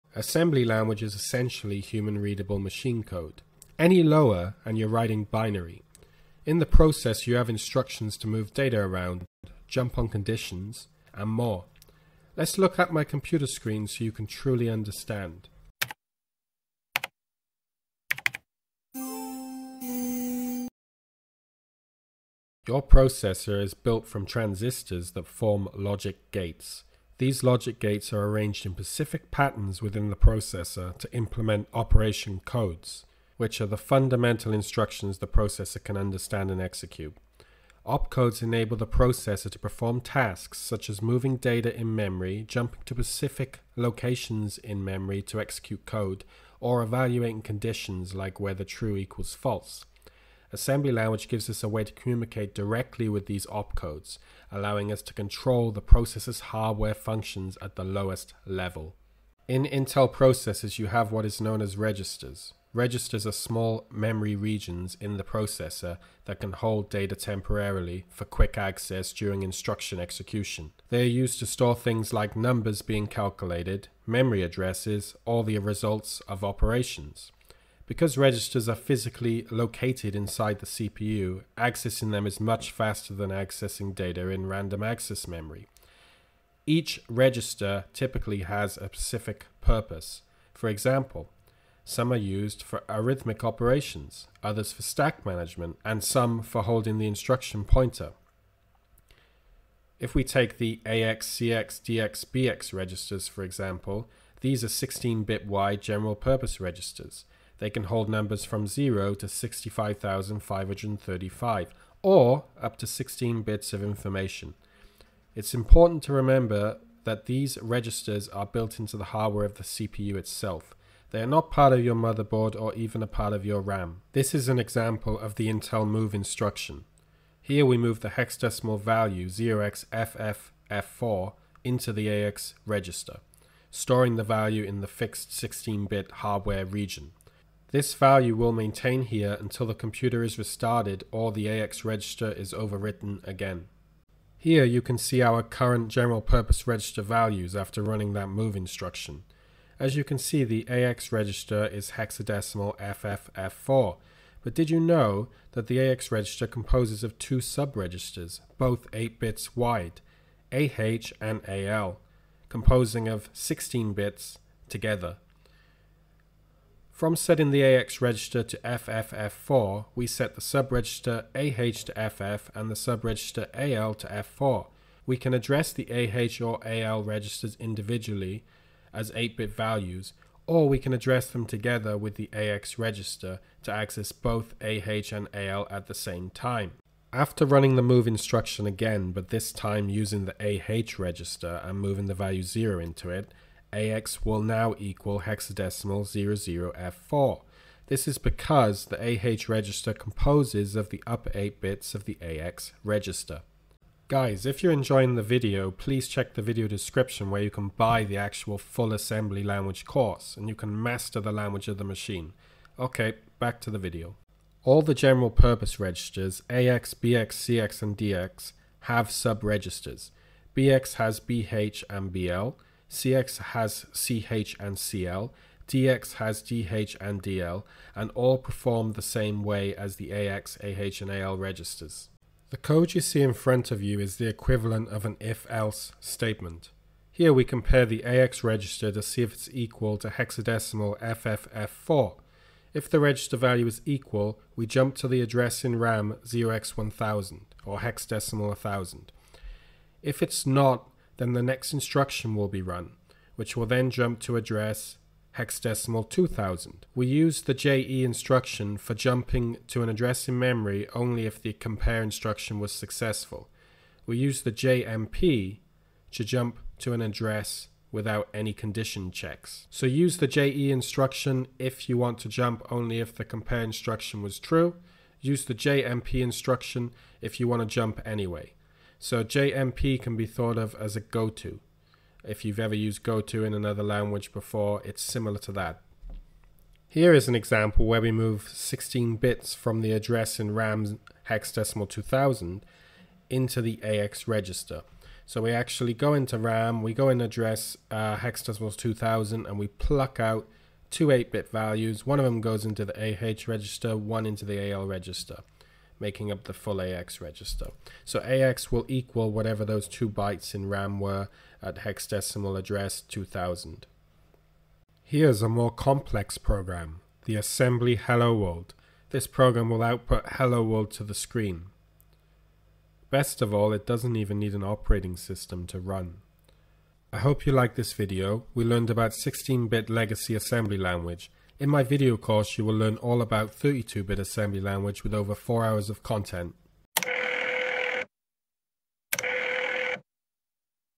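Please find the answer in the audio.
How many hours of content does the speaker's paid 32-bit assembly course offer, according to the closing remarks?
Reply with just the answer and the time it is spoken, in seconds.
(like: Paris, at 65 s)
over 4 hours, at 335 s.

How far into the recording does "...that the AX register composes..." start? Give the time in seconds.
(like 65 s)
155 s.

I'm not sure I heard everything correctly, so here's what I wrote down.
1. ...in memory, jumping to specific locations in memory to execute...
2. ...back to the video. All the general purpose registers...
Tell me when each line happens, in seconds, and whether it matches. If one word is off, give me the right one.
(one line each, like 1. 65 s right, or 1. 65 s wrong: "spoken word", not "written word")
1. 41 s right
2. 213 s right.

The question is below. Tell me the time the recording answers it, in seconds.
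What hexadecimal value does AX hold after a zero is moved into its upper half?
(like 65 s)
196 s.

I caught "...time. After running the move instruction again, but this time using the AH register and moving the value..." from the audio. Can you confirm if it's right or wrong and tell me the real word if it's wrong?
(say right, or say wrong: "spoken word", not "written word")
right.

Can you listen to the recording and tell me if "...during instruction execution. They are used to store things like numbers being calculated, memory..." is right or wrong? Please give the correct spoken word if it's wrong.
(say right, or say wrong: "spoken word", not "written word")
right.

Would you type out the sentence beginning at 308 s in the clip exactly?
So AX will equal whatever those two bytes in RAM were at hexadecimal address 2000.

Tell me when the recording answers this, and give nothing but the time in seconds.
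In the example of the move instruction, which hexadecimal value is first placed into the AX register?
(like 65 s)
129 s.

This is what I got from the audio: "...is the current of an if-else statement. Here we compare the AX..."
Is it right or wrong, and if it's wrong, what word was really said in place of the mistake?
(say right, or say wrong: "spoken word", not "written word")
wrong: "equivalent", not "current".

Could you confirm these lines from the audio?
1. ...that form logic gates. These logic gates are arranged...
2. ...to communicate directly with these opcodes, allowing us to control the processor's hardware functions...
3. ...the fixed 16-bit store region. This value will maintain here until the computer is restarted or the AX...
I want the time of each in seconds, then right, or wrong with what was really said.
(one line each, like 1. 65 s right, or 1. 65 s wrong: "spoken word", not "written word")
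1. 25 s right
2. 51 s right
3. 134 s wrong: "hardware", not "store".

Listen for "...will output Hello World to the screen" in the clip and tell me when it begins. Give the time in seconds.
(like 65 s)
319 s.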